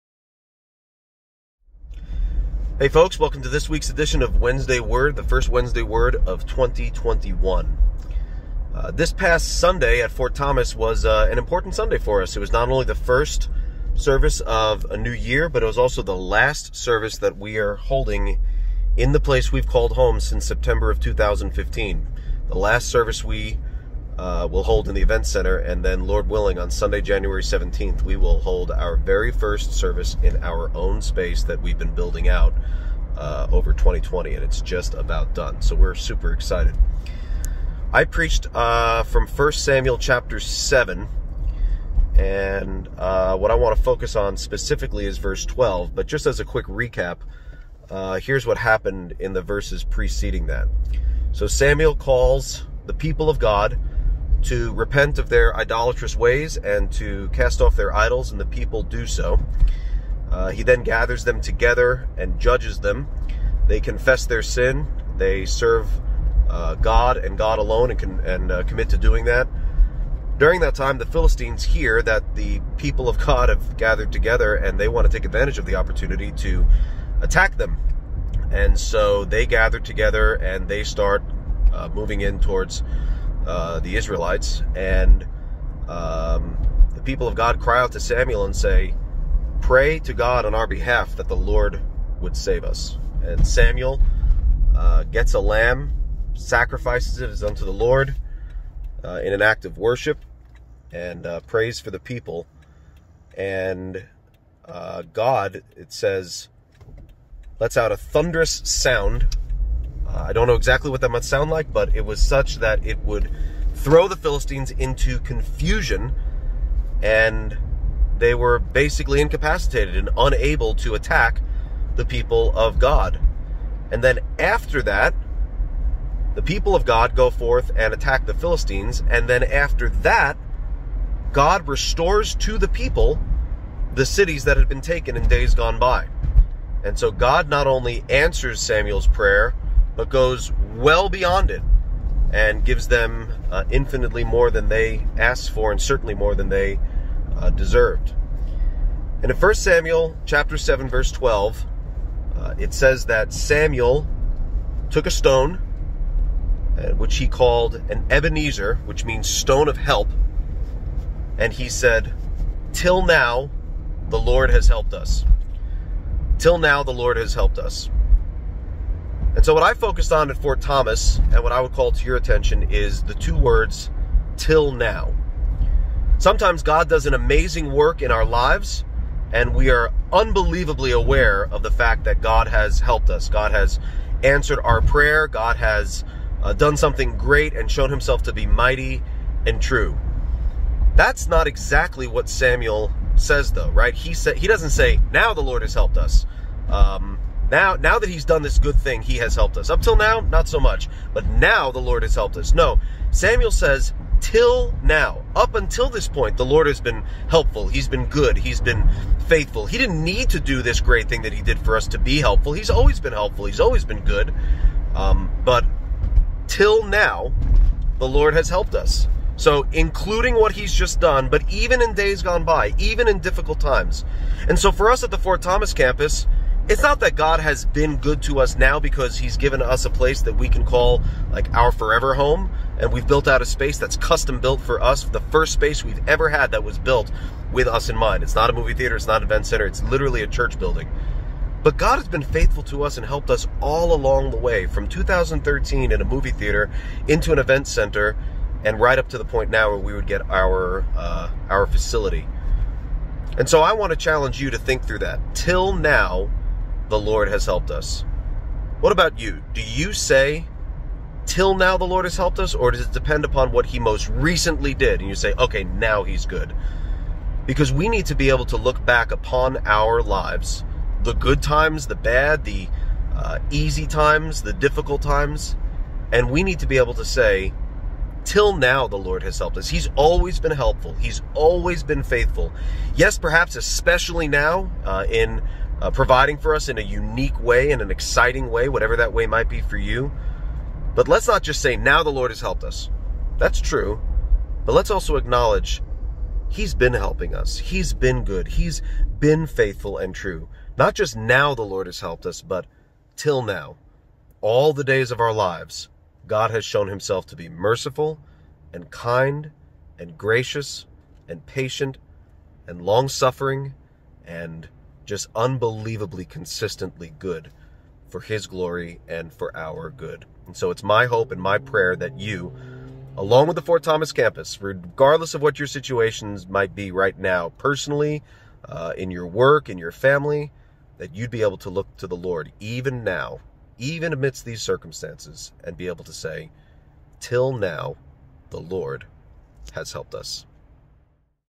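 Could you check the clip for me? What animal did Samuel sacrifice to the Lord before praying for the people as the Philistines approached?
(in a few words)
A lamb.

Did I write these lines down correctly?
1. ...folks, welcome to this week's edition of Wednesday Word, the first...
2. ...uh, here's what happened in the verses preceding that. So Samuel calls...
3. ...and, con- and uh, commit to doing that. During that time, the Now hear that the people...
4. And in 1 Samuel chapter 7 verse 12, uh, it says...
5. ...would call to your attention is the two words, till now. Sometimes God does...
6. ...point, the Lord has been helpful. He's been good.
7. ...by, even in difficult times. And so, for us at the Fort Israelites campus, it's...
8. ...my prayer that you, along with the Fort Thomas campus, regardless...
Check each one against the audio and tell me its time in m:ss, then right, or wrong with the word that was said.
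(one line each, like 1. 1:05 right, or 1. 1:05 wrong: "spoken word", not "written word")
1. 0:02 right
2. 0:47 right
3. 1:07 wrong: "Philistines", not "Now"
4. 2:29 right
5. 2:51 right
6. 3:26 right
7. 3:42 wrong: "Thomas", not "Israelites"
8. 5:21 right.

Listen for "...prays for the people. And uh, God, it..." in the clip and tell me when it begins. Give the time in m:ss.
1:41.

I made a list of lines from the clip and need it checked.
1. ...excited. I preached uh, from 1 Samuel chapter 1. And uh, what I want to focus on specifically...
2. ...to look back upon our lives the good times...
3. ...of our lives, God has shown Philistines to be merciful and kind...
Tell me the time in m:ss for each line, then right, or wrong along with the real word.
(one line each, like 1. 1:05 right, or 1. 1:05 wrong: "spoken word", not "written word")
1. 0:36 wrong: "7", not "1"
2. 4:28 right
3. 5:05 wrong: "Himself", not "Philistines".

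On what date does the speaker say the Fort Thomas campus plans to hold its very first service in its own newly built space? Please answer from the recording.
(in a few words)
January 17th.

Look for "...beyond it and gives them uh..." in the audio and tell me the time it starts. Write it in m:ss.
2:21.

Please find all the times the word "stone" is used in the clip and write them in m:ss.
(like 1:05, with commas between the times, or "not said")
2:35, 2:39.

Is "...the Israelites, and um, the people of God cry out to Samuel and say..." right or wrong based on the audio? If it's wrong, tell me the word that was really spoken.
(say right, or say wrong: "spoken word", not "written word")
right.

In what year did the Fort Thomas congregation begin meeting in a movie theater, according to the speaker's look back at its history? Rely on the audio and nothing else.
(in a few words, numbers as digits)
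2013.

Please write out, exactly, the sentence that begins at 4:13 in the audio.
And so I want to challenge you to think through that.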